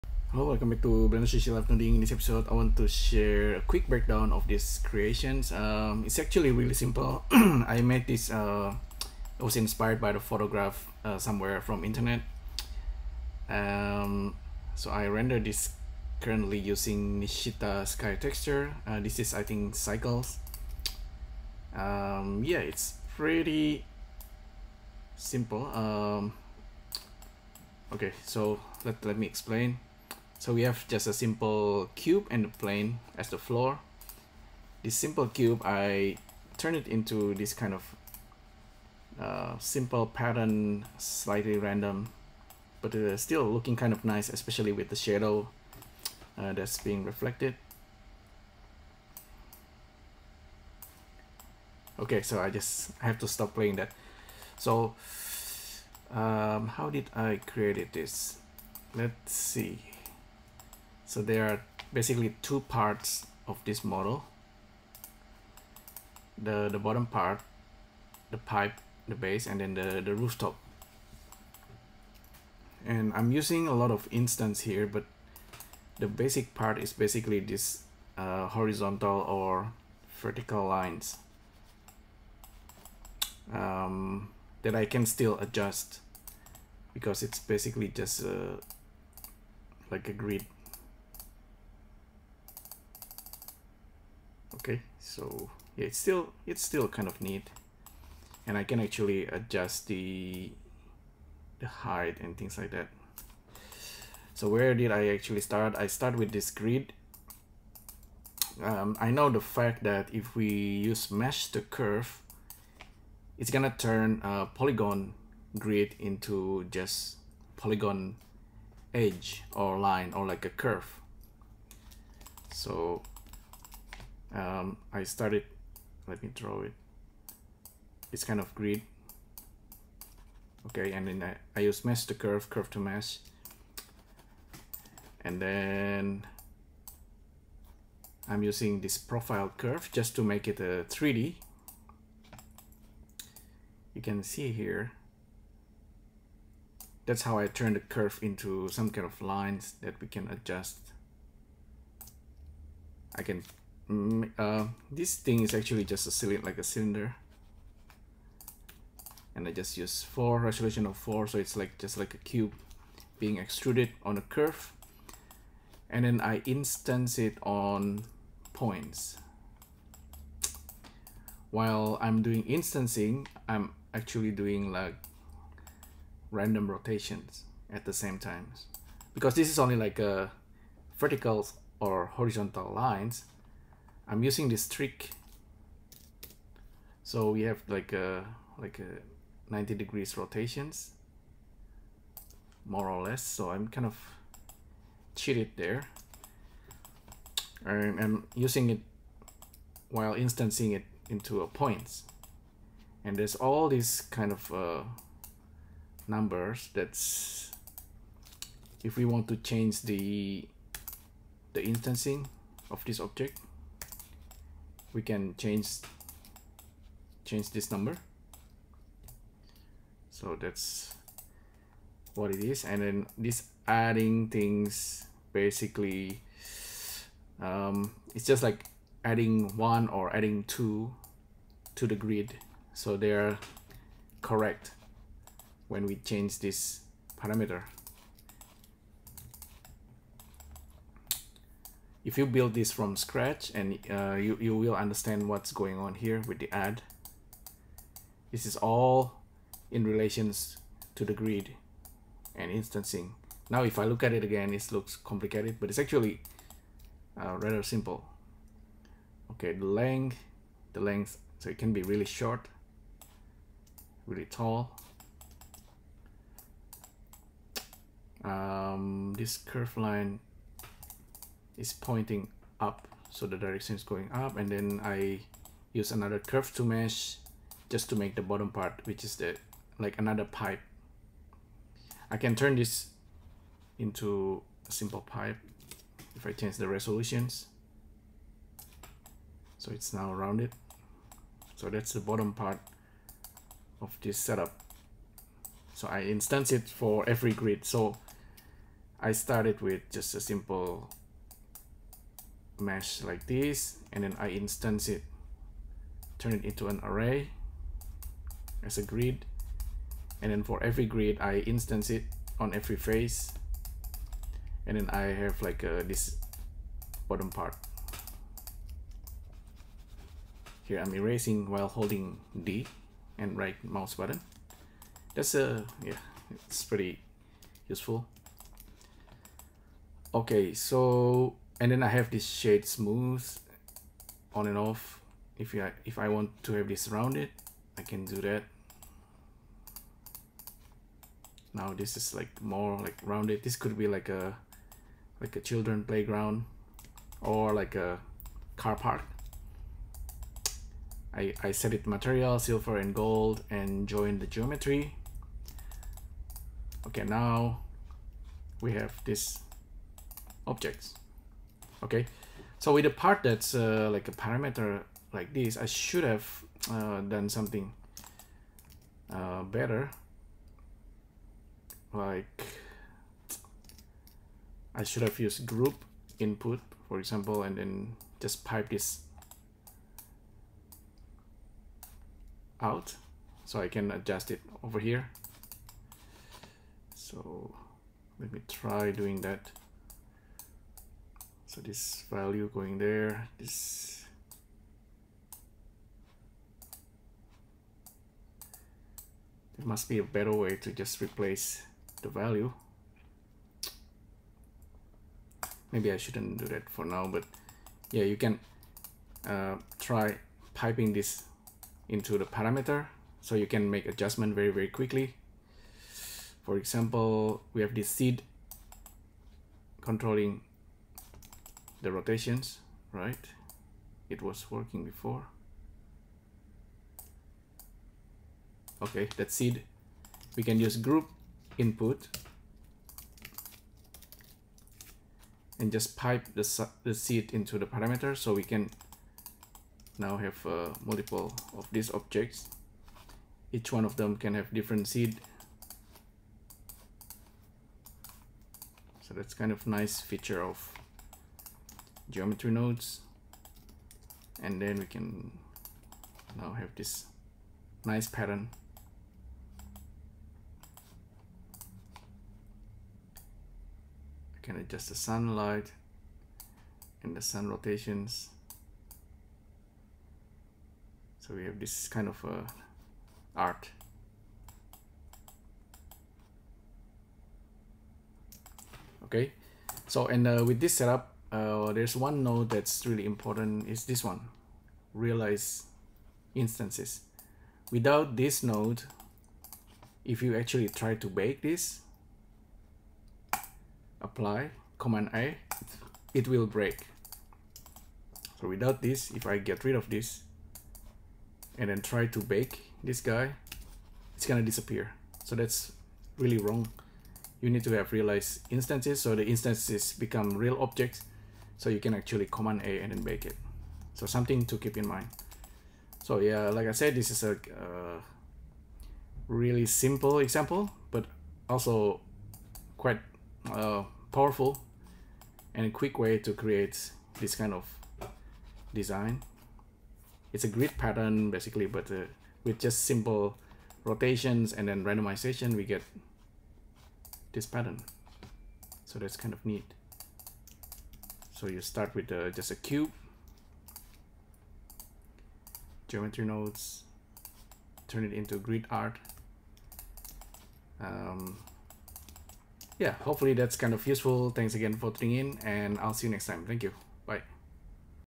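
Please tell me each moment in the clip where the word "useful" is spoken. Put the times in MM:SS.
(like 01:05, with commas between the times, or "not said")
05:27, 09:13.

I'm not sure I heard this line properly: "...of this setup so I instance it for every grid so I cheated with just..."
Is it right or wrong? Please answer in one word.
wrong.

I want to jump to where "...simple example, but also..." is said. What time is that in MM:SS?
08:39.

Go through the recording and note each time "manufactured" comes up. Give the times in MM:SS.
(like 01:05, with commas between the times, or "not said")
not said.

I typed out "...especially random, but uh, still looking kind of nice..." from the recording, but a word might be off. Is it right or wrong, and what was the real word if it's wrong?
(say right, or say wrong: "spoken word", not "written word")
wrong: "slightly", not "especially".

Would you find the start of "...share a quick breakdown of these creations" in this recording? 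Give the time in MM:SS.
00:02.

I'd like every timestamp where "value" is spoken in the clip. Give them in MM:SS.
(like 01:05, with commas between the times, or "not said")
06:32, 06:42.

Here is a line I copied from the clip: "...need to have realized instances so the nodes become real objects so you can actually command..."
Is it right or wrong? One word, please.
wrong.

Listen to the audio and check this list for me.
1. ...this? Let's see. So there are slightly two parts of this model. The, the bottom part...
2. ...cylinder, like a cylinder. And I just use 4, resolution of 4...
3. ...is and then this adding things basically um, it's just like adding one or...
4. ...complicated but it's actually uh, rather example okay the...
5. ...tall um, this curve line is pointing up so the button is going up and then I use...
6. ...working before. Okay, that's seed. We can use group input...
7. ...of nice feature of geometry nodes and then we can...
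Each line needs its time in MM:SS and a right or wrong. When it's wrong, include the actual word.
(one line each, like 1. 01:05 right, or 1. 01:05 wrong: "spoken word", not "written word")
1. 00:57 wrong: "basically", not "slightly"
2. 02:36 right
3. 03:42 right
4. 04:14 wrong: "simple", not "example"
5. 04:24 wrong: "direction", not "button"
6. 07:04 right
7. 07:29 right.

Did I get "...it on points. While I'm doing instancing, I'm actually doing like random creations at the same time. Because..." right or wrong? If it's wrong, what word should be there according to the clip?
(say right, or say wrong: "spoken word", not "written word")
wrong: "rotations", not "creations".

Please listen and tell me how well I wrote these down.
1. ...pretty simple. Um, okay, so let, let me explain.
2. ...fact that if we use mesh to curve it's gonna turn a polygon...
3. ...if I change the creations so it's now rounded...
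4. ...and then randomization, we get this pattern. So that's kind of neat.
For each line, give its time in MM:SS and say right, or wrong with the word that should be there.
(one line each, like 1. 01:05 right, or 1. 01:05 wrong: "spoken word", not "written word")
1. 00:23 right
2. 01:49 right
3. 04:46 wrong: "resolutions", not "creations"
4. 08:54 right.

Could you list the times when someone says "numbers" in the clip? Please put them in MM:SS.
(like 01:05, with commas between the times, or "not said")
03:26, 03:37.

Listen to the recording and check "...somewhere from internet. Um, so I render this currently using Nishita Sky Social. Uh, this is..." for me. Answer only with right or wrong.
wrong.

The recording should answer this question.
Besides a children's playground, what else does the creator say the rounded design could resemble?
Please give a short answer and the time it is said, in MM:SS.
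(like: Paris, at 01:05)
A car park, at 05:47.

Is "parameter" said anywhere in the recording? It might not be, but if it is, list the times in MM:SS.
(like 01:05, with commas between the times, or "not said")
03:57, 06:04, 06:52, 07:17.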